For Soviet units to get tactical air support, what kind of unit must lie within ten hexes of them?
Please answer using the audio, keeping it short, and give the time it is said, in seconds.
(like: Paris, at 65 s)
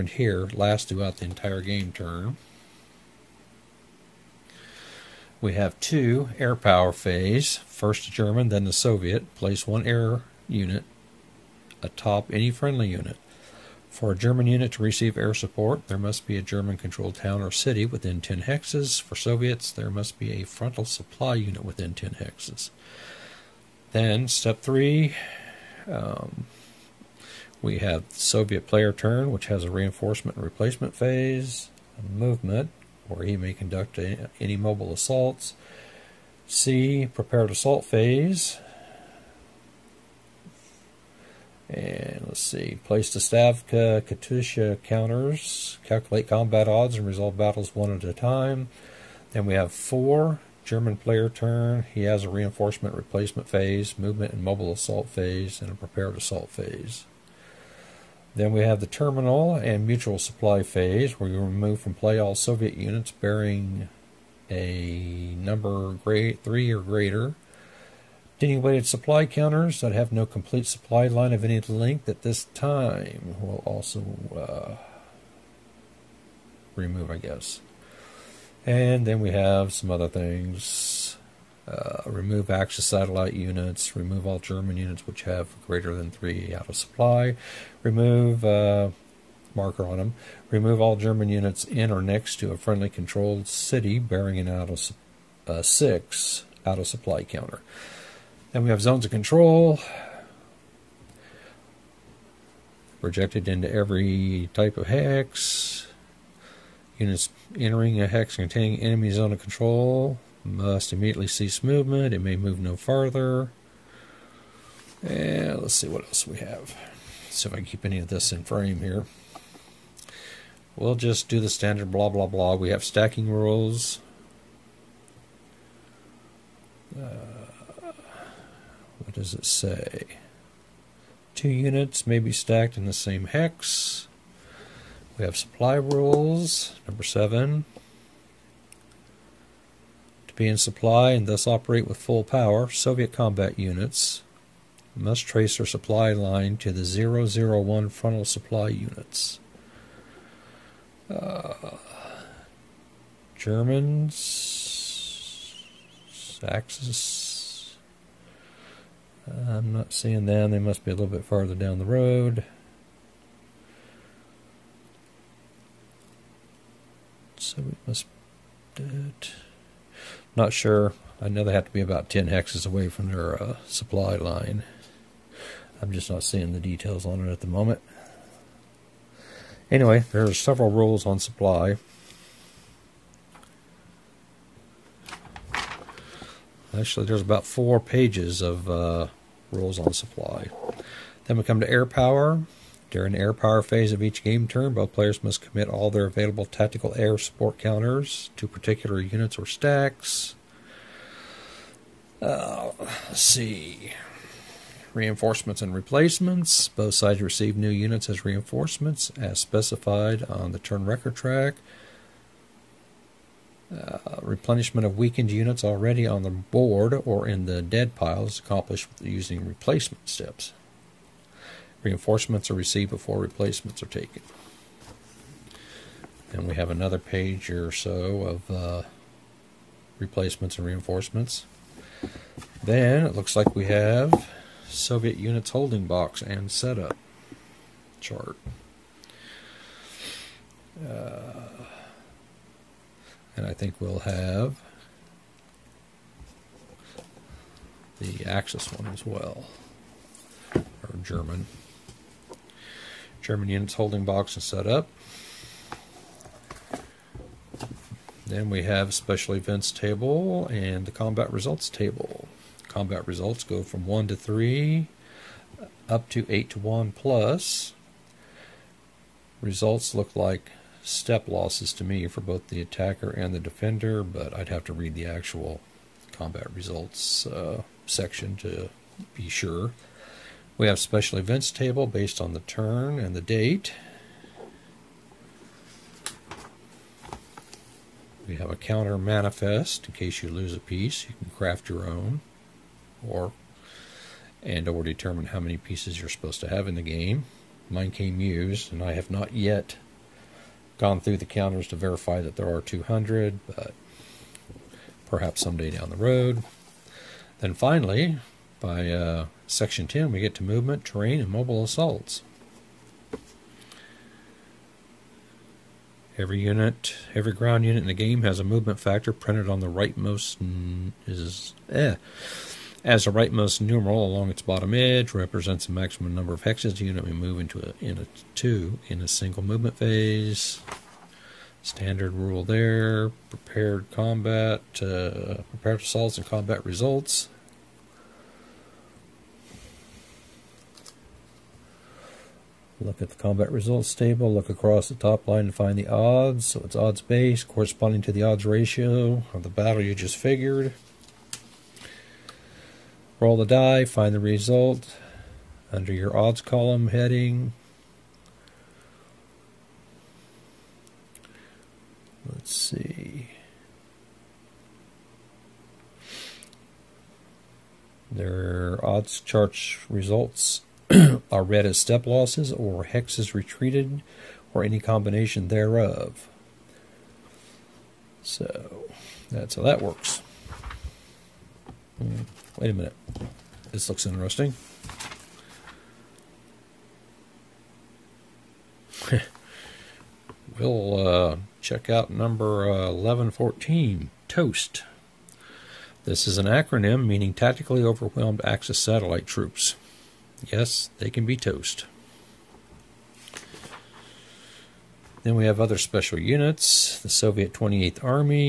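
Frontal supply unit, at 20 s.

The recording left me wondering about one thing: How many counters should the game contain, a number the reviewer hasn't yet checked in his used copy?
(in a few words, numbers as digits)
200.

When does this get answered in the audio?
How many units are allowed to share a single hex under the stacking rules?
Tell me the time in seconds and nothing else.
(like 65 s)
131 s.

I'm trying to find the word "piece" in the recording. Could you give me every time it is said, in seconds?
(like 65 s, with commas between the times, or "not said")
290 s, 295 s.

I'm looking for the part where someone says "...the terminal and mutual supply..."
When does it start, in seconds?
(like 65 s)
58 s.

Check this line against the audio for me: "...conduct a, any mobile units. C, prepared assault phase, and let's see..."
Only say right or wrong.
wrong.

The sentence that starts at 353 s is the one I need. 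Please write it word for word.
Roll the die, find the result under your odds column heading.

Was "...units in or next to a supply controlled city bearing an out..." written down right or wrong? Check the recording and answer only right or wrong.
wrong.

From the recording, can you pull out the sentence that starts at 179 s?
Anyway, there are several rules on supply.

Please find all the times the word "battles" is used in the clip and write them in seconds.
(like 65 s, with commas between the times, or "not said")
47 s, 349 s.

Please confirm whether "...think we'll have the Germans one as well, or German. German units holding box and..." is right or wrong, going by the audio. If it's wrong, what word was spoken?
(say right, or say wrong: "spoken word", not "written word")
wrong: "Axis", not "Germans".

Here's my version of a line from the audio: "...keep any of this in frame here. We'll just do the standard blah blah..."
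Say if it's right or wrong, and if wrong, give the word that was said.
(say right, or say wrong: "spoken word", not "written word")
right.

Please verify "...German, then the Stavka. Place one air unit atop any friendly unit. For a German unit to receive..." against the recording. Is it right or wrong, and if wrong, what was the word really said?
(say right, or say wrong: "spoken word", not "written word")
wrong: "Soviet", not "Stavka".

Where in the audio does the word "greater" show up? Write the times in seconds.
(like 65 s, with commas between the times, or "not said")
66 s, 85 s.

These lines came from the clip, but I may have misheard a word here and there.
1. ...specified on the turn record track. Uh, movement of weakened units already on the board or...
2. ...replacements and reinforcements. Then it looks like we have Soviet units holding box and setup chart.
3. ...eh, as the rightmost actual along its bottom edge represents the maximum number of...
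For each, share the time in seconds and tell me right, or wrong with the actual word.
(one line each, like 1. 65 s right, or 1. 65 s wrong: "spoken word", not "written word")
1. 209 s wrong: "replenishment", not "movement"
2. 229 s right
3. 321 s wrong: "numeral", not "actual".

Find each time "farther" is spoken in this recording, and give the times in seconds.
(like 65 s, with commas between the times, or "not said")
112 s, 161 s.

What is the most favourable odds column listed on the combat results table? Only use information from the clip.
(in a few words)
8 to 1 plus.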